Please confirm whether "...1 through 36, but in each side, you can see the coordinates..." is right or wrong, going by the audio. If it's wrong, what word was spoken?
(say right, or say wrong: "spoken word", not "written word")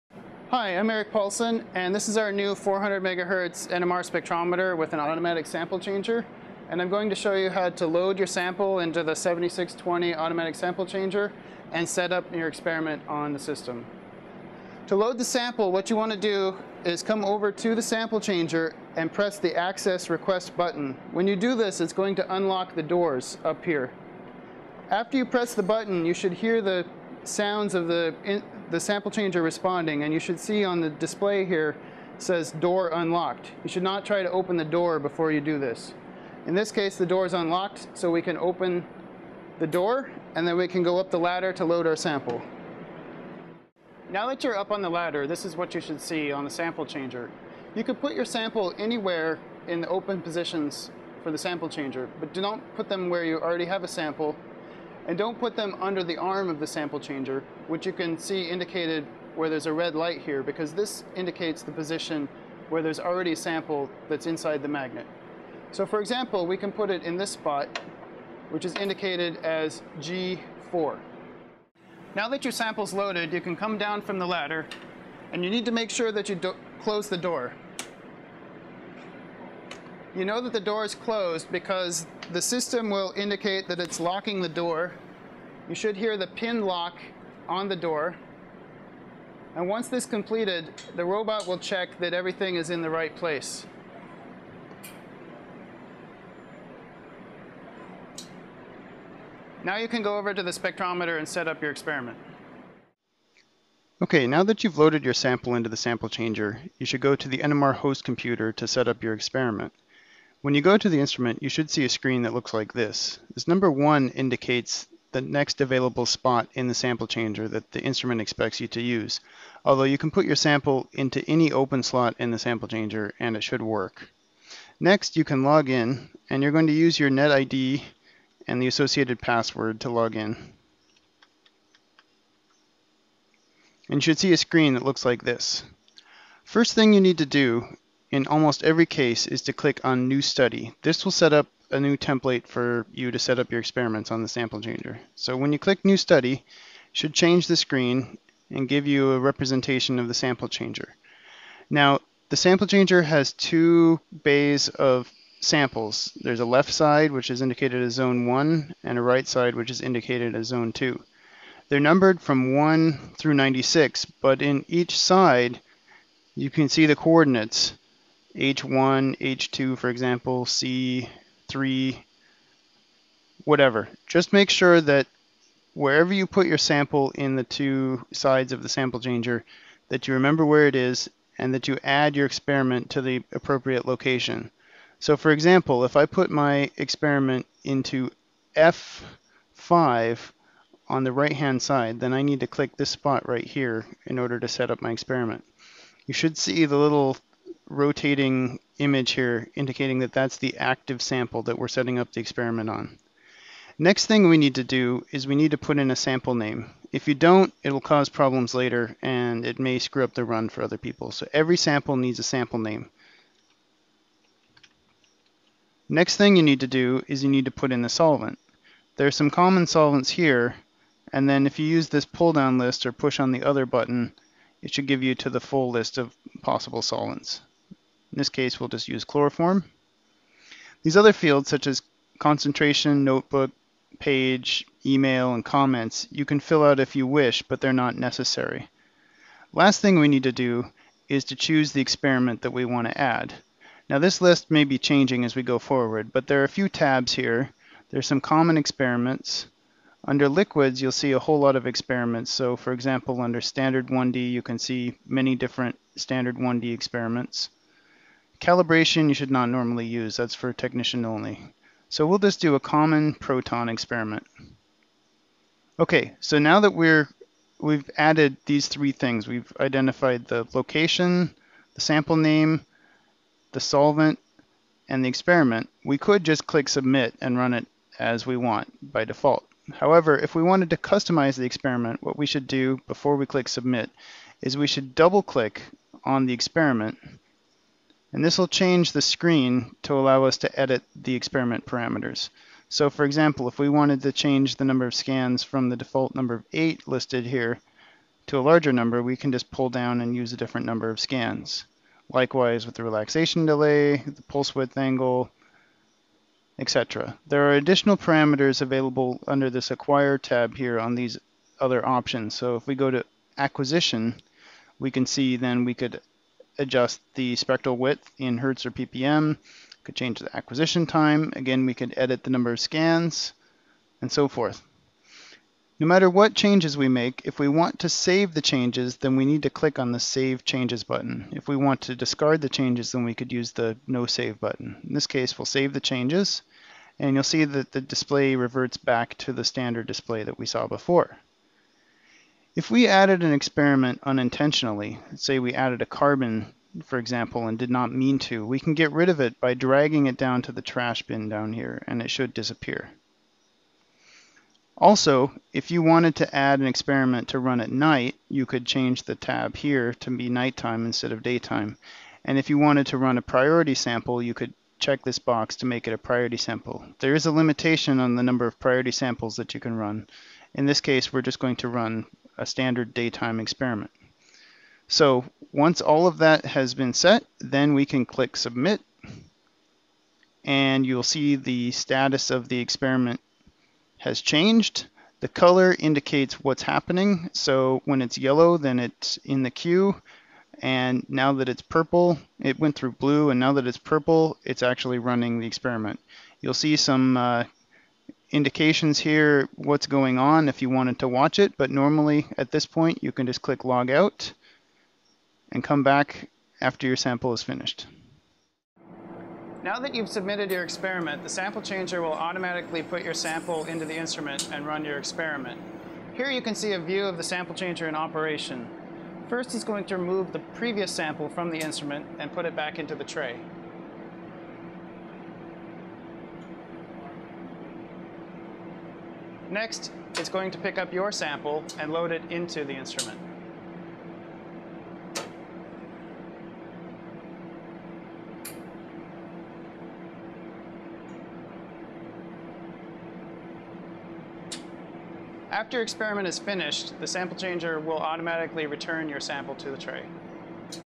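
wrong: "96", not "36".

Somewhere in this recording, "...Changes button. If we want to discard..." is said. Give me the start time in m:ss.
5:30.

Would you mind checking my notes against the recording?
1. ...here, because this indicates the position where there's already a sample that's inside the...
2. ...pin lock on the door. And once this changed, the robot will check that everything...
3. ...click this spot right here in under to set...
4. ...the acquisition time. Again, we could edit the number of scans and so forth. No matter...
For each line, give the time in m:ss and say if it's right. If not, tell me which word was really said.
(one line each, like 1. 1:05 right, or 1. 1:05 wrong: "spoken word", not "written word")
1. 1:00 right
2. 1:26 wrong: "completed", not "changed"
3. 3:12 wrong: "order", not "under"
4. 5:20 right.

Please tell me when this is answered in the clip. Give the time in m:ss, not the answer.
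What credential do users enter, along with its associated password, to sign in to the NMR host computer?
2:07.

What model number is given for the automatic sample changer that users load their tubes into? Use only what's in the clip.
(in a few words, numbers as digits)
7620.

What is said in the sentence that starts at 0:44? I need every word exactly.
Now that you're up on the ladder, this is what you should see on the sample changer.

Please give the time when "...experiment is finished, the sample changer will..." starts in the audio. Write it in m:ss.
7:25.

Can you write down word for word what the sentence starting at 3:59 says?
Last thing we need to do is to choose the experiment that we want to add.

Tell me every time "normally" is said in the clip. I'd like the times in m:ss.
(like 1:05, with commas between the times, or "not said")
4:19, 6:41.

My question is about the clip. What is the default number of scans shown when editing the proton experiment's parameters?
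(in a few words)
8.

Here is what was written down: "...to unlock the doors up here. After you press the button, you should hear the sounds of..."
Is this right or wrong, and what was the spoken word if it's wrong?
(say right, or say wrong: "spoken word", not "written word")
right.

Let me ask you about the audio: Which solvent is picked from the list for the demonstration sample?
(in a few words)
Chloroform.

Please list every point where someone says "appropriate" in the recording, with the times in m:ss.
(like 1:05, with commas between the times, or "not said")
3:03.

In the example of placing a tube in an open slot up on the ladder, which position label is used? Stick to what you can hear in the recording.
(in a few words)
G4.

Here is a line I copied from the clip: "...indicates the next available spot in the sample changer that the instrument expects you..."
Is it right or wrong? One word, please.
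right.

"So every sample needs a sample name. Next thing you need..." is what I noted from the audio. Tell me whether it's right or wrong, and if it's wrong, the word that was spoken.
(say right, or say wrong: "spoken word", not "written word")
right.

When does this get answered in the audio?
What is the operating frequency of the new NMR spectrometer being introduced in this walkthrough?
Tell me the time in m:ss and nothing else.
0:02.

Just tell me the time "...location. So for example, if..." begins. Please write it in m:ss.
3:03.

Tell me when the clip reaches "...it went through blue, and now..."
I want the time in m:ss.
6:32.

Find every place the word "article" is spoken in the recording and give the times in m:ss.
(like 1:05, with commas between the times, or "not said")
not said.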